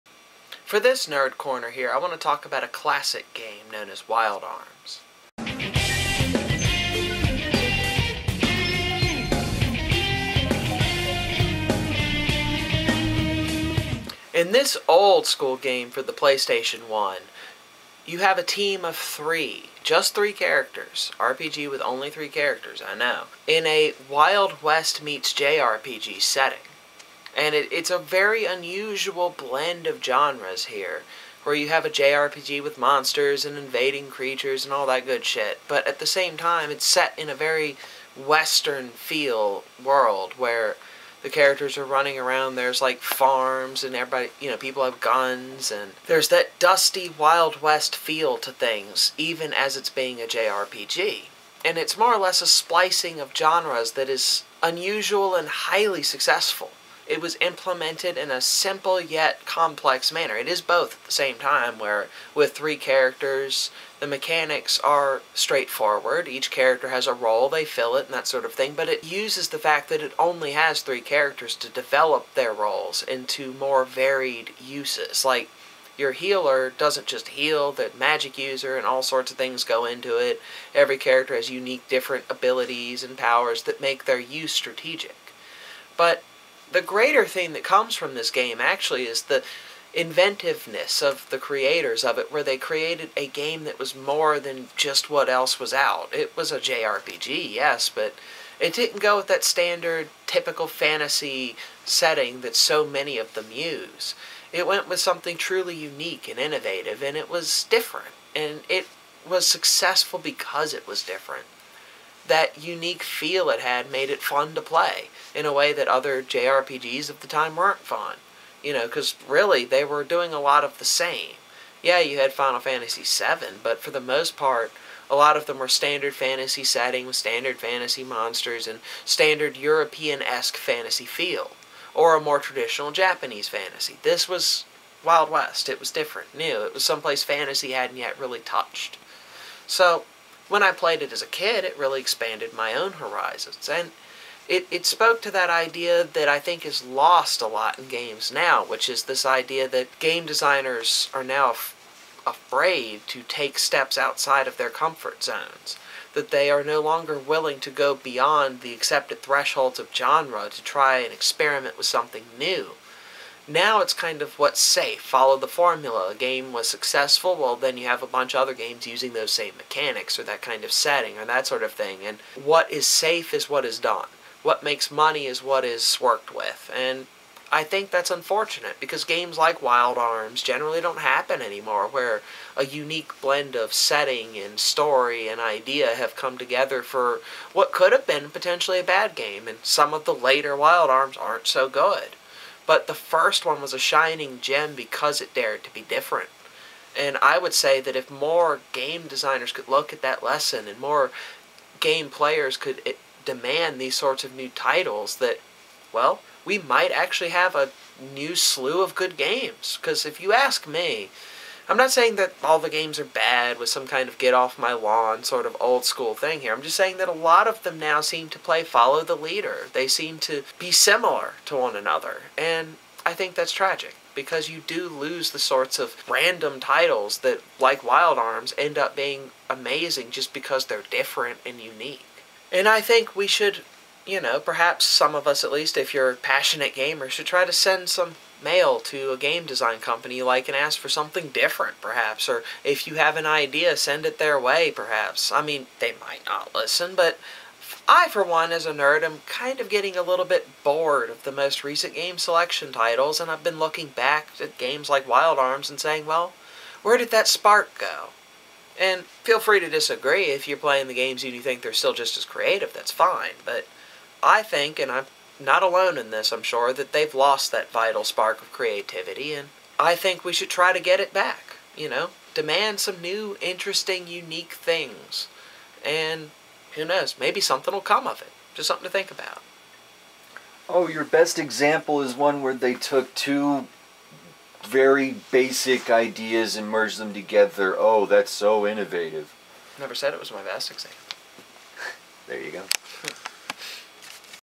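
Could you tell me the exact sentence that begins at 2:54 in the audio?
What makes money is what is worked with.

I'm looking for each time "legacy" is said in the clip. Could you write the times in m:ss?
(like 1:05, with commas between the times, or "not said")
not said.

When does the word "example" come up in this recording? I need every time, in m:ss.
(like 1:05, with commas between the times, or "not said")
4:41, 4:50.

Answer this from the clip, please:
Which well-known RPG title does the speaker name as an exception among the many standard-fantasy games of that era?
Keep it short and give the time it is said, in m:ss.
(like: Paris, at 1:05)
Final Fantasy VII, at 2:02.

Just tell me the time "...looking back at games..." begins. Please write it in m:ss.
4:13.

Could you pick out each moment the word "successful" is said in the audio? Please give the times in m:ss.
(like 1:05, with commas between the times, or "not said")
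0:56, 1:49, 2:46.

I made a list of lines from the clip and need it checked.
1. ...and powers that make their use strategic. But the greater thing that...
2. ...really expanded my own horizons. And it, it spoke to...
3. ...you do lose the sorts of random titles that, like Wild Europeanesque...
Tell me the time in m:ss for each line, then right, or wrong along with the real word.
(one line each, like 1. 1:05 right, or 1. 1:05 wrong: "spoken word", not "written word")
1. 1:23 right
2. 2:21 right
3. 3:44 wrong: "Arms", not "Europeanesque".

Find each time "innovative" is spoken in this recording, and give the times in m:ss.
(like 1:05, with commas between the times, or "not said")
1:46, 4:48.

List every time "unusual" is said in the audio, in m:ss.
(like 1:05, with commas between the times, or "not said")
0:28, 0:54.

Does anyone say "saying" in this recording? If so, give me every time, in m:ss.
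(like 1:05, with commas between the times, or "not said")
3:31, 3:36, 4:15.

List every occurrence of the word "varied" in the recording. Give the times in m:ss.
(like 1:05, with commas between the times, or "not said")
1:13.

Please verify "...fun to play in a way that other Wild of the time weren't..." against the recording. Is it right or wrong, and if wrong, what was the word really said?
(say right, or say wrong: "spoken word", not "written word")
wrong: "JRPGs", not "Wild".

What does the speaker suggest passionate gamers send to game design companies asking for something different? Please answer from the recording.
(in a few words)
Mail.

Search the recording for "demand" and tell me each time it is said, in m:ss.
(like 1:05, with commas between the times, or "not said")
3:23, 4:32.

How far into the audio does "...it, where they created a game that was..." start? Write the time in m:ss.
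1:32.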